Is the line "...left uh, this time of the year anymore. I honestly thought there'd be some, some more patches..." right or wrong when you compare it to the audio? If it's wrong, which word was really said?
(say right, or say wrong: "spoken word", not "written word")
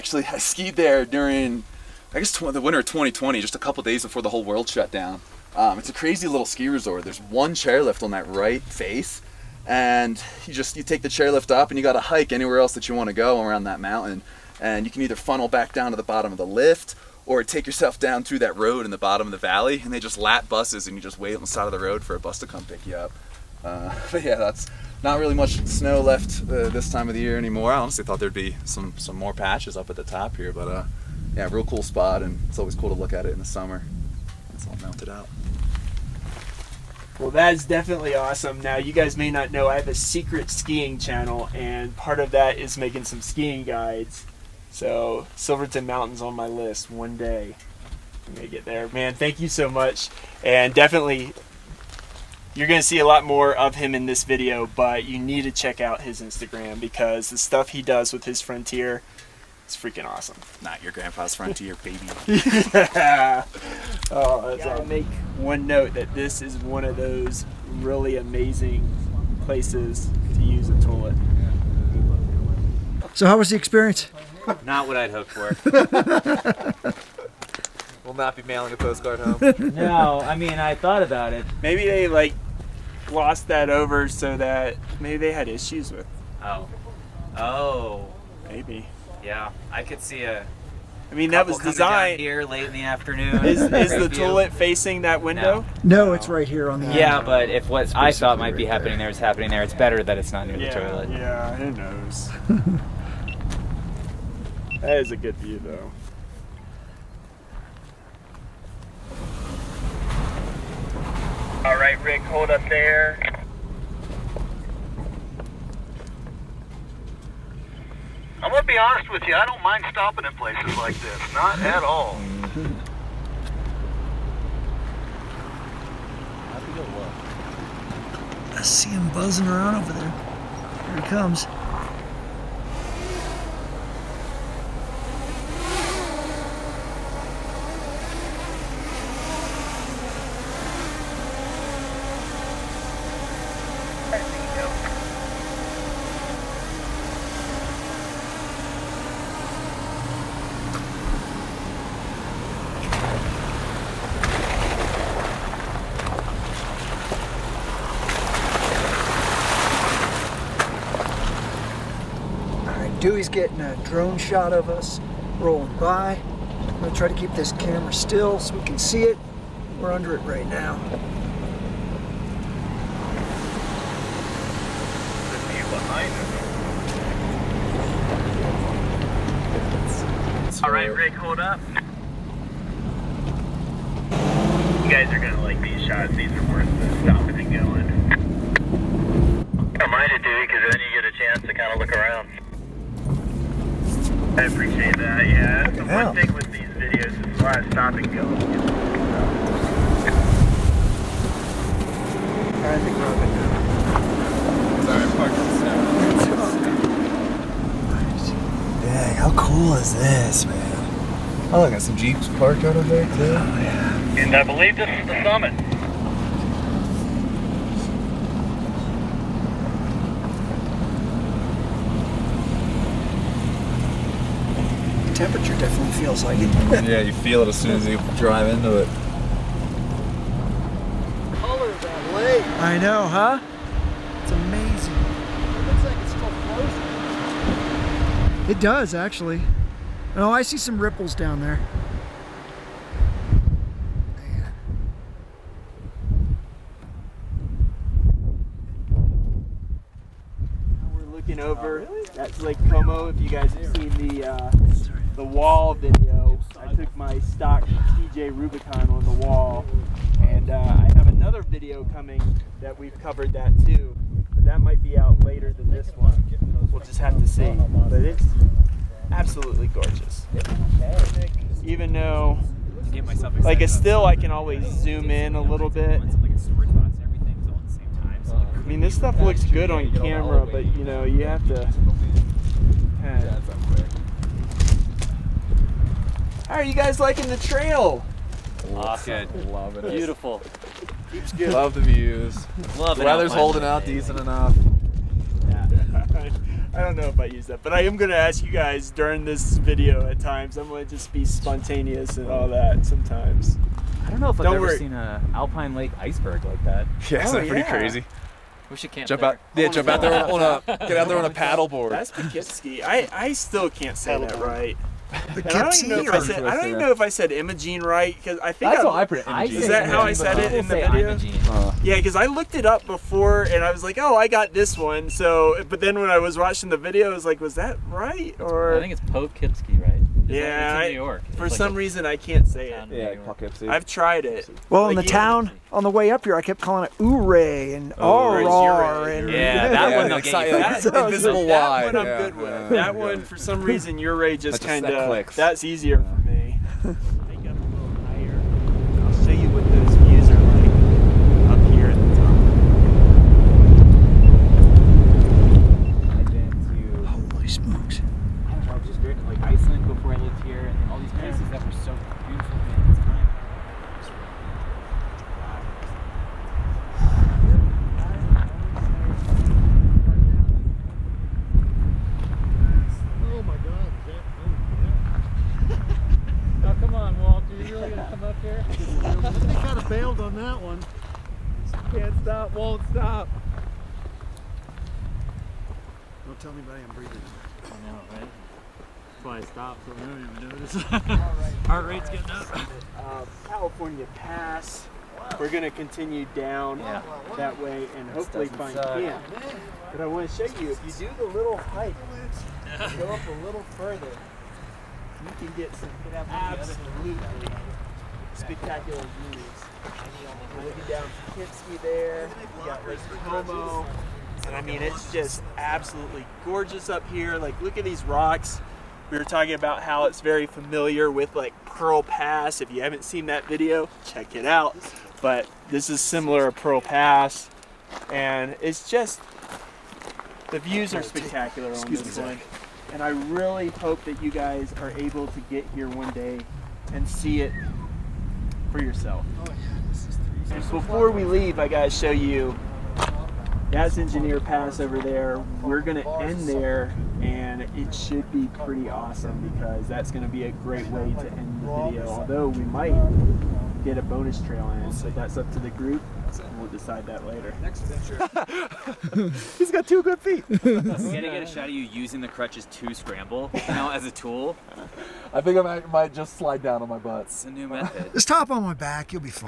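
right.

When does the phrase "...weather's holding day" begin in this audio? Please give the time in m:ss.
4:53.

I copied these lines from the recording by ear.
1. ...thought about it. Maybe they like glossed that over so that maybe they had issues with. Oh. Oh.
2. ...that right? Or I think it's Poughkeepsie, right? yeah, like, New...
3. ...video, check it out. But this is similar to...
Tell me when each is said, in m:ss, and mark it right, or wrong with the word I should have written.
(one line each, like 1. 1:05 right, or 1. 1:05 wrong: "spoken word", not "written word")
1. 1:20 right
2. 5:27 right
3. 7:03 right.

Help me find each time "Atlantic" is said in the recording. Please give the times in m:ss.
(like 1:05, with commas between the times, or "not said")
not said.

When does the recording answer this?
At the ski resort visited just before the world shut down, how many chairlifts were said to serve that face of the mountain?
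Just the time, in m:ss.
0:07.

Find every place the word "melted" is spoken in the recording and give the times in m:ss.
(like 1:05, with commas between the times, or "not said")
0:34.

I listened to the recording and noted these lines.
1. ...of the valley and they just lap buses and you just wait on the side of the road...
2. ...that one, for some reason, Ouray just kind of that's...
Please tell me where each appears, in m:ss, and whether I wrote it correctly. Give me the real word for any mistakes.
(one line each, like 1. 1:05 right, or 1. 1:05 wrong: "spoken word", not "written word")
1. 0:19 right
2. 5:42 right.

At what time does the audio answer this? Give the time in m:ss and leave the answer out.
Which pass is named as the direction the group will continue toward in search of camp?
6:33.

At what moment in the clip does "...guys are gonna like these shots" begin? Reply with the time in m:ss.
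3:04.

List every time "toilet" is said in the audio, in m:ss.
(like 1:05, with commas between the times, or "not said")
1:10, 1:34, 1:40.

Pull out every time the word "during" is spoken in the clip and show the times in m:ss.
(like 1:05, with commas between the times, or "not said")
0:01, 4:58.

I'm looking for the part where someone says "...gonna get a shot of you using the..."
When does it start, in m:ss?
7:40.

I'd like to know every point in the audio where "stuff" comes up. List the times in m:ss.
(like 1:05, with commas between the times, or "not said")
0:57, 4:38.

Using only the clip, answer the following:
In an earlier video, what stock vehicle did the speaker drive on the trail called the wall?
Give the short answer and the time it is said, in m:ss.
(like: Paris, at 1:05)
TJ Rubicon, at 4:17.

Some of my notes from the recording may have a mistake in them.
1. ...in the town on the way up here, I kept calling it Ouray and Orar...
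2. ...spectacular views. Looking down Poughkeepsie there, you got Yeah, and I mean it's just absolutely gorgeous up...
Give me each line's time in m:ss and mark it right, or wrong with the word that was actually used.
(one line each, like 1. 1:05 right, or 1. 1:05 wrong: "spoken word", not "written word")
1. 5:34 right
2. 6:48 wrong: "Como", not "Yeah".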